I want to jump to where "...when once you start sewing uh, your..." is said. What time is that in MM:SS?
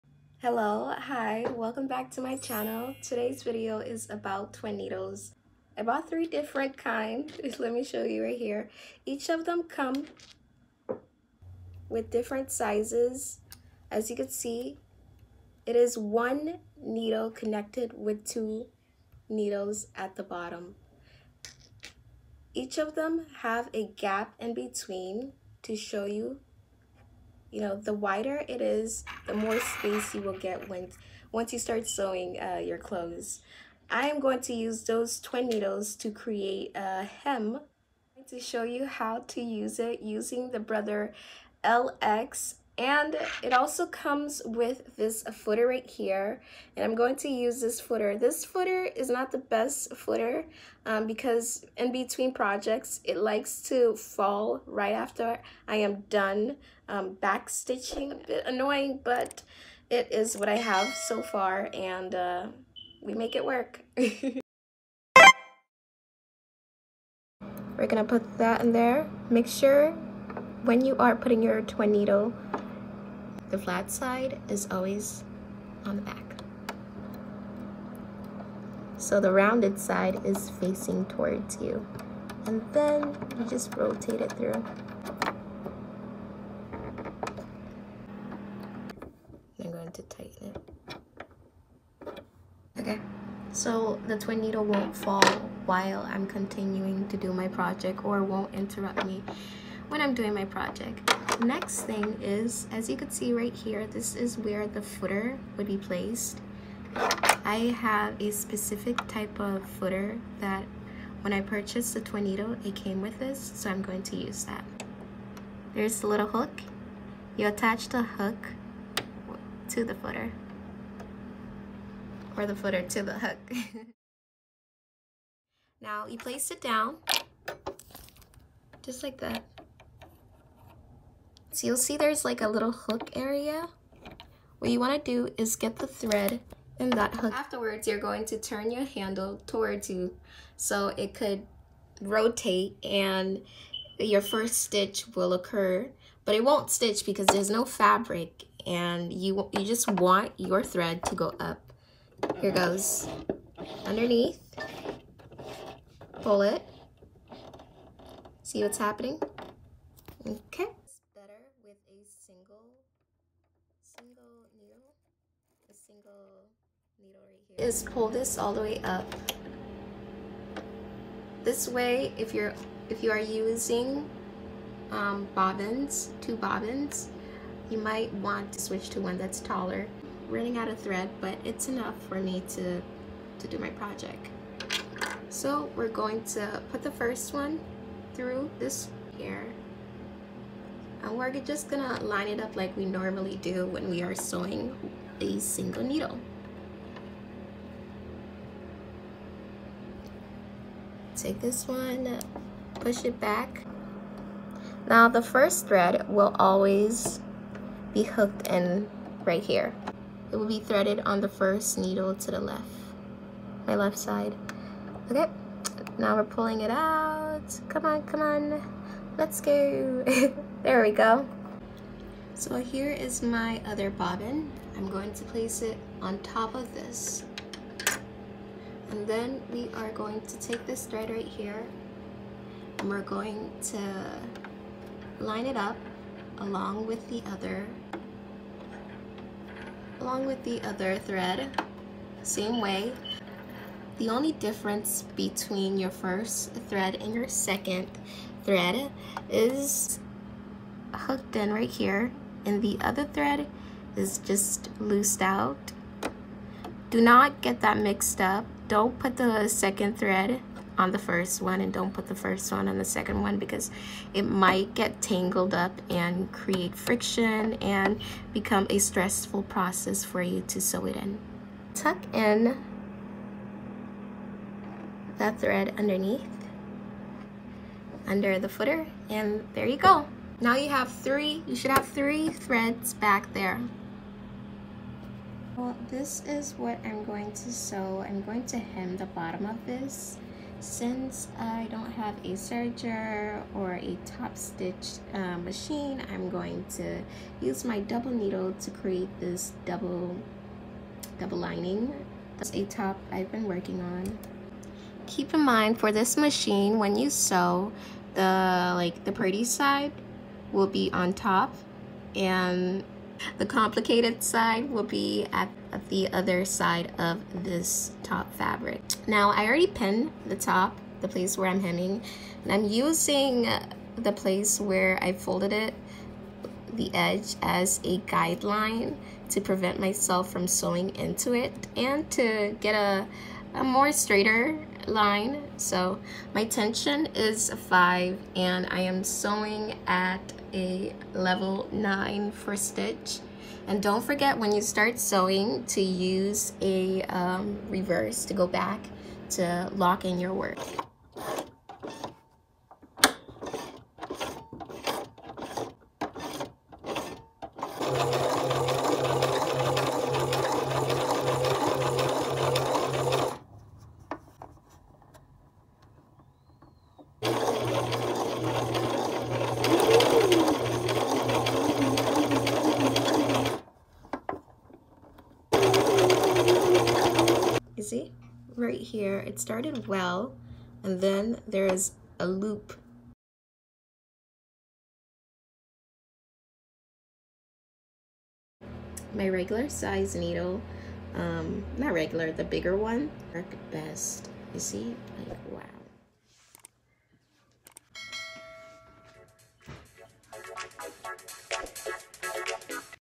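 00:30.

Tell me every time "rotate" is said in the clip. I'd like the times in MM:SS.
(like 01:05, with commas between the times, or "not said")
01:23, 02:21.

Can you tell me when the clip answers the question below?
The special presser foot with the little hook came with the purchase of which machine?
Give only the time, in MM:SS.
01:51.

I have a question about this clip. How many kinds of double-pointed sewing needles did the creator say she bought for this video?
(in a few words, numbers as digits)
3.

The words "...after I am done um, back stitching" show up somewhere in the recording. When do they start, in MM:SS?
00:54.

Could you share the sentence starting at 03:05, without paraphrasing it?
So we're going to put the first one through this here.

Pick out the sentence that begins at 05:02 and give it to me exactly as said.
That's a top I've been working on.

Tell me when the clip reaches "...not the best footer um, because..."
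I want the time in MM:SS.
00:49.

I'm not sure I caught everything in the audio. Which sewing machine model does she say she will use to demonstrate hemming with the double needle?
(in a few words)
Brother LX.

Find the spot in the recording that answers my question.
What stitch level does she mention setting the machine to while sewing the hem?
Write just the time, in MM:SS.
05:41.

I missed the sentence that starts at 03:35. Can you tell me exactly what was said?
Okay, now we're pulling it out.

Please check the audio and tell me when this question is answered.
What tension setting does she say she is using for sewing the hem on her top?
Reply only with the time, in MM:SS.
05:37.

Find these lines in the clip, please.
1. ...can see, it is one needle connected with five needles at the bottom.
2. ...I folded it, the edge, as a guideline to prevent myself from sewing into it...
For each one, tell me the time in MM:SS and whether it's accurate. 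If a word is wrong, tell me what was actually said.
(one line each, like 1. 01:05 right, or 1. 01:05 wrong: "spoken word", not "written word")
1. 00:14 wrong: "two", not "five"
2. 05:25 right.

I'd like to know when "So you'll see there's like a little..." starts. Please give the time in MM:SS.
02:11.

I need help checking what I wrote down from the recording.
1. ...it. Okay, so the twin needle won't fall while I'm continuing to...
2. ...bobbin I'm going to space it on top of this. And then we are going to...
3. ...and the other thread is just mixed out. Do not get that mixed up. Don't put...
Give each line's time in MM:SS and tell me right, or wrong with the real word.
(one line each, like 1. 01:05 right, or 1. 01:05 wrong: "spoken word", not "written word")
1. 01:30 right
2. 03:43 wrong: "place", not "space"
3. 04:12 wrong: "loosed", not "mixed".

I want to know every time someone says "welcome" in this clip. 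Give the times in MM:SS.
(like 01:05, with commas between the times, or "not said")
00:01.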